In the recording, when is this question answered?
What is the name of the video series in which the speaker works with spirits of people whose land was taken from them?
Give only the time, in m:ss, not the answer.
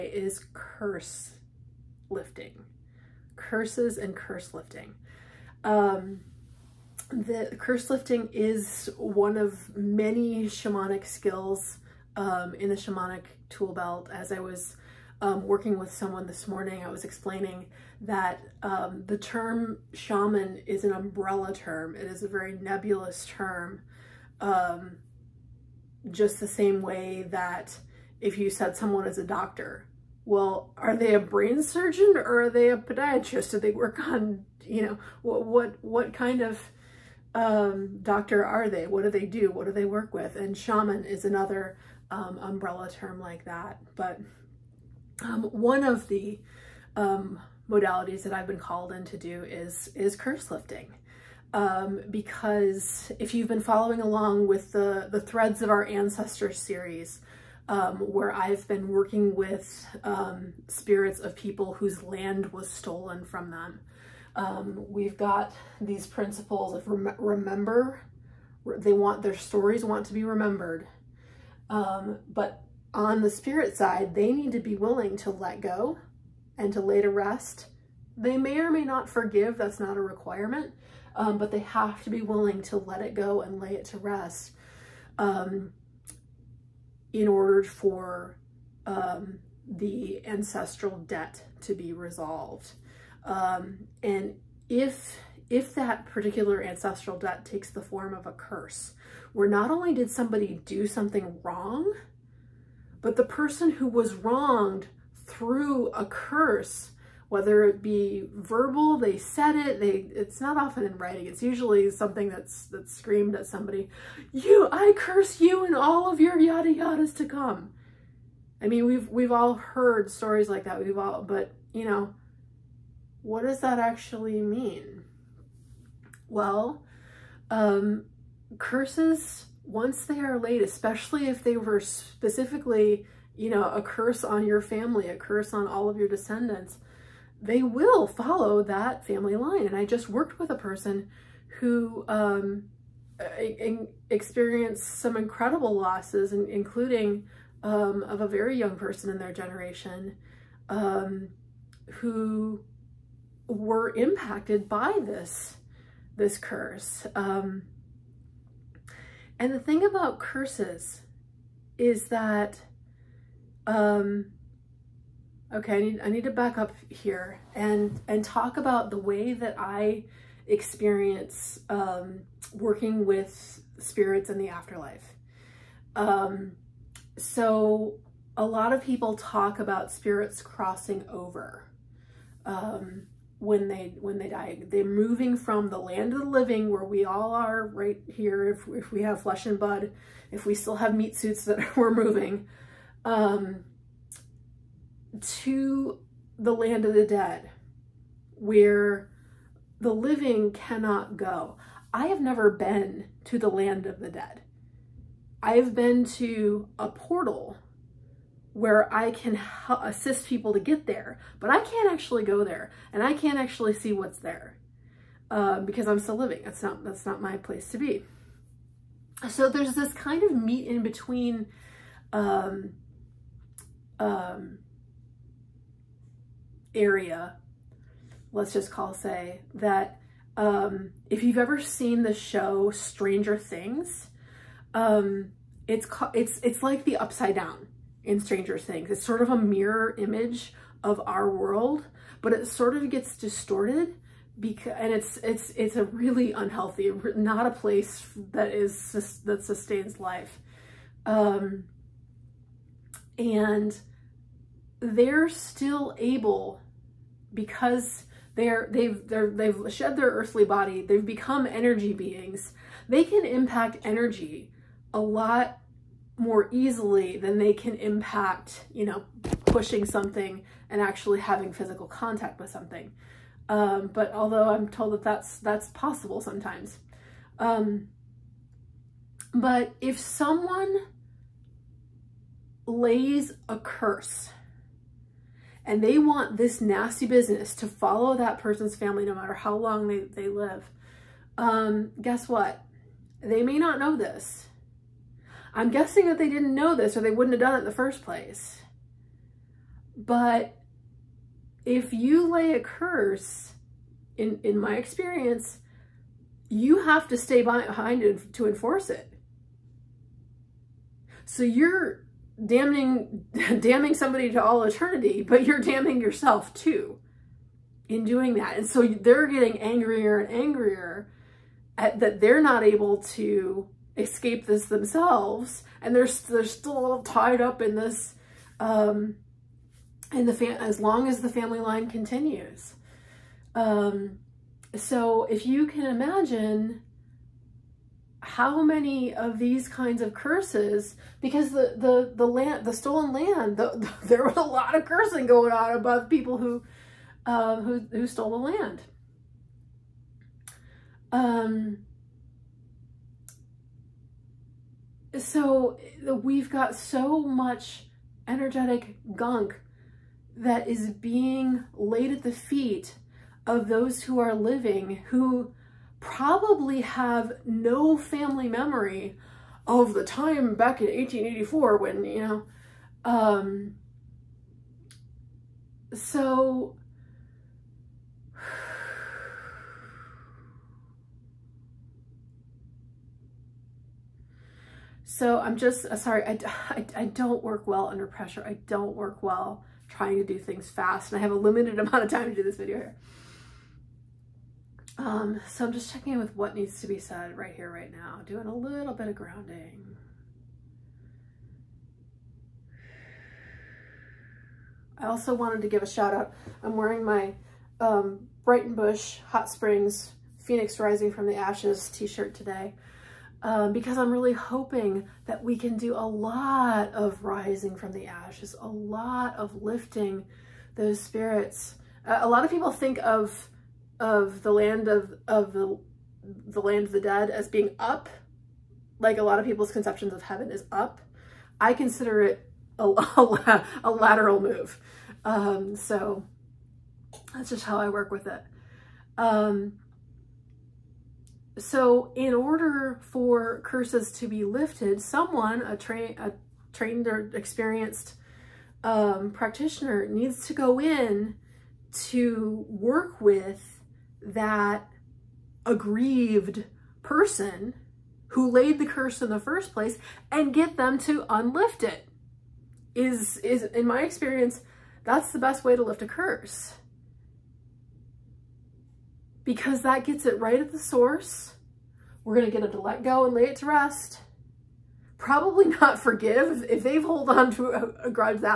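0:55.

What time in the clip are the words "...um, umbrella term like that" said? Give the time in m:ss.
0:42.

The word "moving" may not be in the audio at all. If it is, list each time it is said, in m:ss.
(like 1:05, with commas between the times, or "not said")
3:04, 3:11.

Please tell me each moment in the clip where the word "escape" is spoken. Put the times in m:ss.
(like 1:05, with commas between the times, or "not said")
5:23.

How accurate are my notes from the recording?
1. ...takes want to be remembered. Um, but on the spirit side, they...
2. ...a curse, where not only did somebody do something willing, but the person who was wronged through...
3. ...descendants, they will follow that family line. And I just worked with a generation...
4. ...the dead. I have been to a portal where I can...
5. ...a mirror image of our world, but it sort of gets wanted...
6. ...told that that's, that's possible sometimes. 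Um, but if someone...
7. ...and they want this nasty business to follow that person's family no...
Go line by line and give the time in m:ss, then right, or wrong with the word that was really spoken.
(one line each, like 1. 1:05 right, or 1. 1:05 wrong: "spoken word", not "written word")
1. 1:09 wrong: "stories", not "takes"
2. 1:38 wrong: "wrong", not "willing"
3. 2:16 wrong: "person", not "generation"
4. 3:23 right
5. 3:59 wrong: "distorted", not "wanted"
6. 4:34 right
7. 4:45 right.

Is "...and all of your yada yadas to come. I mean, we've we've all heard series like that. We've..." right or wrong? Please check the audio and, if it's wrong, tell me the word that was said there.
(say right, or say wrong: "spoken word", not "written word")
wrong: "stories", not "series".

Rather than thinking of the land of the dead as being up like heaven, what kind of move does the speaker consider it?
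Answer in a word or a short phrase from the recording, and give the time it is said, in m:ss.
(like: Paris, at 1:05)
a lateral move, at 7:13.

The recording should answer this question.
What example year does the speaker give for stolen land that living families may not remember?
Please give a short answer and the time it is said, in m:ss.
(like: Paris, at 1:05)
1884, at 6:10.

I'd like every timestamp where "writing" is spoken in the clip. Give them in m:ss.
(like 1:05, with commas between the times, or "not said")
1:50.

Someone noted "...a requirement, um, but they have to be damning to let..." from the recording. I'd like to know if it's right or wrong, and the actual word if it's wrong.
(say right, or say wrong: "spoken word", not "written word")
wrong: "willing", not "damning".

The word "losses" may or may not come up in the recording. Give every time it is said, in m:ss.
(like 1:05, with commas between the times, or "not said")
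2:25.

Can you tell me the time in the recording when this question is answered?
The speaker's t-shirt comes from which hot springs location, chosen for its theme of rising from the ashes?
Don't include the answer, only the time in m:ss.
6:48.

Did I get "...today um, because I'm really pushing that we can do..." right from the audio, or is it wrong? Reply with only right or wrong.
wrong.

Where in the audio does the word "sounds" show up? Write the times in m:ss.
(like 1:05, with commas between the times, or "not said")
not said.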